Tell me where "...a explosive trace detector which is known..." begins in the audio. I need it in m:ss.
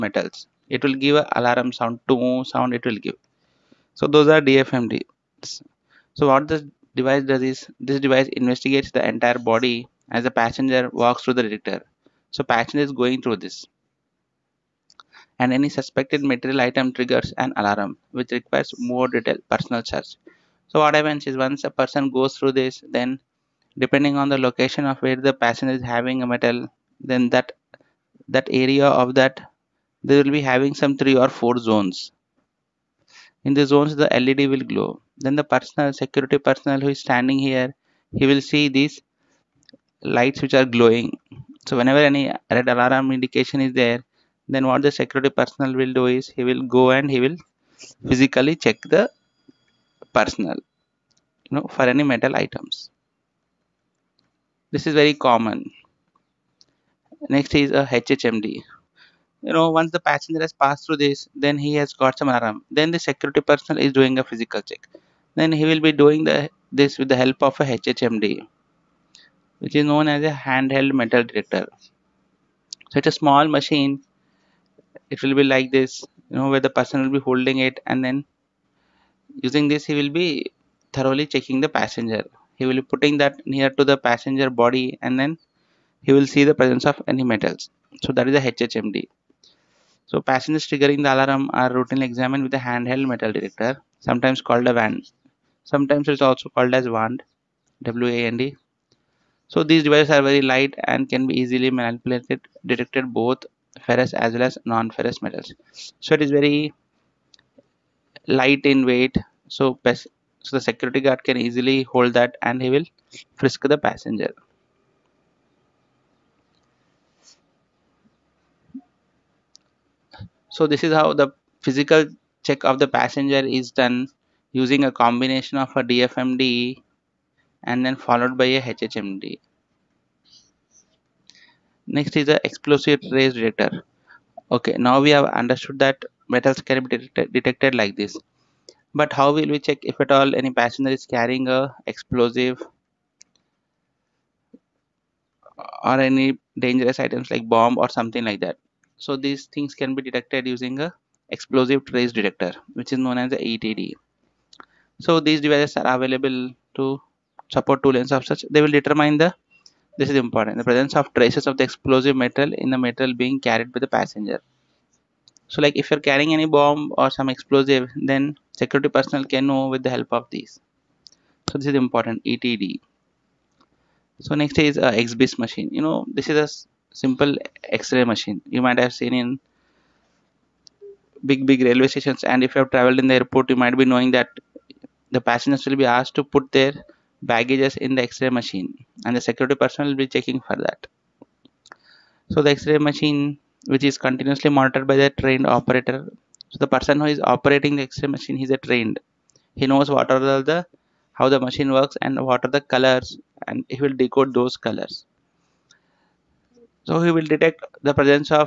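2:30.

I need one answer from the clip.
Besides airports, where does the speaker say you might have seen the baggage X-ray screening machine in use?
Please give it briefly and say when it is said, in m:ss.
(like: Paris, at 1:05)
Big railway stations, at 3:01.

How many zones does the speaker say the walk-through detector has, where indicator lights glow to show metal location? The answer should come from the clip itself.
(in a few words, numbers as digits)
3 or 4.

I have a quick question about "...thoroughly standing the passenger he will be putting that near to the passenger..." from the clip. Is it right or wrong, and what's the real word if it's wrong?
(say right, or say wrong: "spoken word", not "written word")
wrong: "checking", not "standing".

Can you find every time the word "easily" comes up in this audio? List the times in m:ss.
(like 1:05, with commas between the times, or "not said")
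1:41, 1:51.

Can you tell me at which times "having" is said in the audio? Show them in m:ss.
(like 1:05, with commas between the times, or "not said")
0:25, 0:30.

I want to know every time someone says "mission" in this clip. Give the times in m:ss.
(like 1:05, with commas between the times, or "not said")
not said.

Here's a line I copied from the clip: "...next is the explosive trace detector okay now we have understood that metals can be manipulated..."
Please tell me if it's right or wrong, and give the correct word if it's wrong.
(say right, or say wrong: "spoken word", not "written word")
wrong: "detected", not "manipulated".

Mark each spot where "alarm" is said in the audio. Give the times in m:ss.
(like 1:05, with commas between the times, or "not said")
0:01, 0:17, 0:42, 1:02, 1:31.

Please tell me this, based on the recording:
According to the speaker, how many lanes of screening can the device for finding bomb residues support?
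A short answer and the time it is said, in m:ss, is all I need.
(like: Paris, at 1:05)
2, at 2:37.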